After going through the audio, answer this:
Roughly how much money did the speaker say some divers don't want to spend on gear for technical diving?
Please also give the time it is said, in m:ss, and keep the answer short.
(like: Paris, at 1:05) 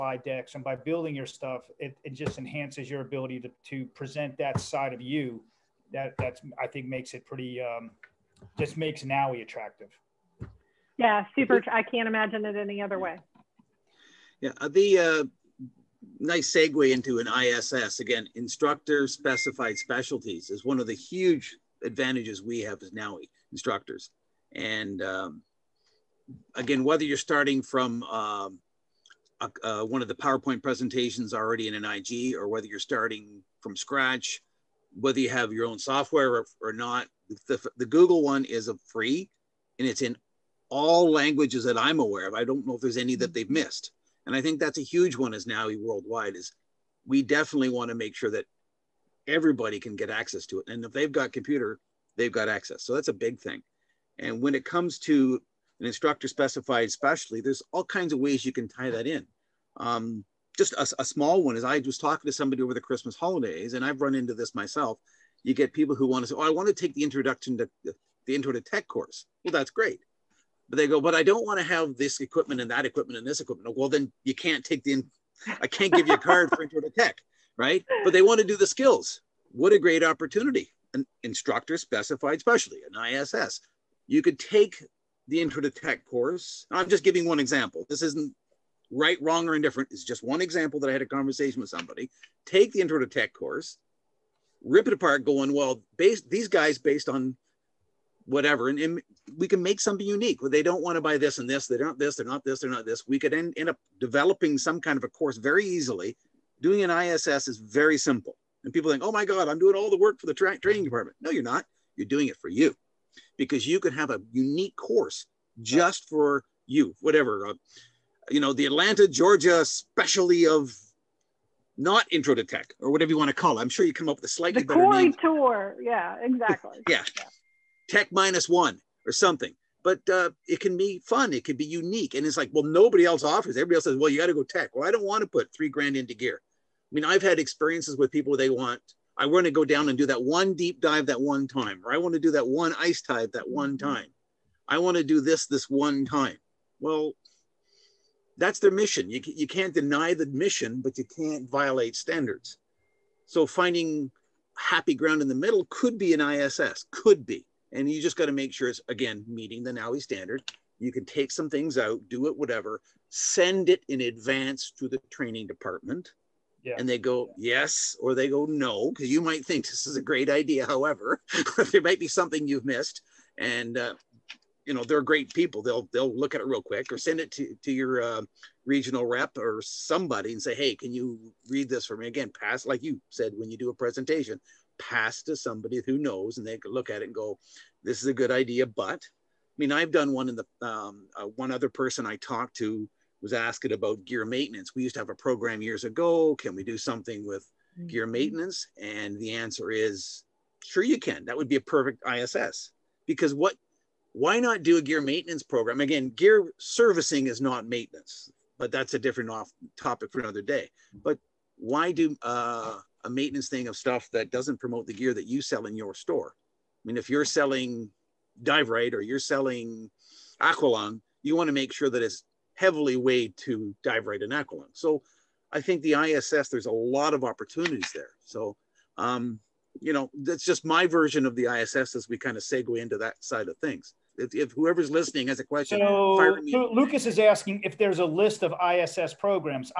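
3 grand, at 2:15.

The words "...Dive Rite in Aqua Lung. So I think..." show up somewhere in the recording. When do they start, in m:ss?
3:43.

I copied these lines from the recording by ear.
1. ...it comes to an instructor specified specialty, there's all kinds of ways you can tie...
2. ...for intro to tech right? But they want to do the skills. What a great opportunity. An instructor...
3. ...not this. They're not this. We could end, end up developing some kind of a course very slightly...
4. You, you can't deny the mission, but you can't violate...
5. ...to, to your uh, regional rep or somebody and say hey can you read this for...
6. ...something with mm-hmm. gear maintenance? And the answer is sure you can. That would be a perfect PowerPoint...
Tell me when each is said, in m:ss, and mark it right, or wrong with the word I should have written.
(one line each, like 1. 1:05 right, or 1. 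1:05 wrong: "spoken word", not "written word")
1. 0:54 right
2. 1:16 right
3. 1:41 wrong: "easily", not "slightly"
4. 2:29 right
5. 2:57 right
6. 3:16 wrong: "ISS", not "PowerPoint".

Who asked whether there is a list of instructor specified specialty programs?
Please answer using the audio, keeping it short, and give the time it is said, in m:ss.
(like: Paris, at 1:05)
Lucas, at 3:56.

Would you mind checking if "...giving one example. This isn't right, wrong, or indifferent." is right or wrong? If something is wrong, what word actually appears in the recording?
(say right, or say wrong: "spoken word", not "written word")
right.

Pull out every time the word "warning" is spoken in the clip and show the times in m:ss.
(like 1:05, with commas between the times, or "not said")
not said.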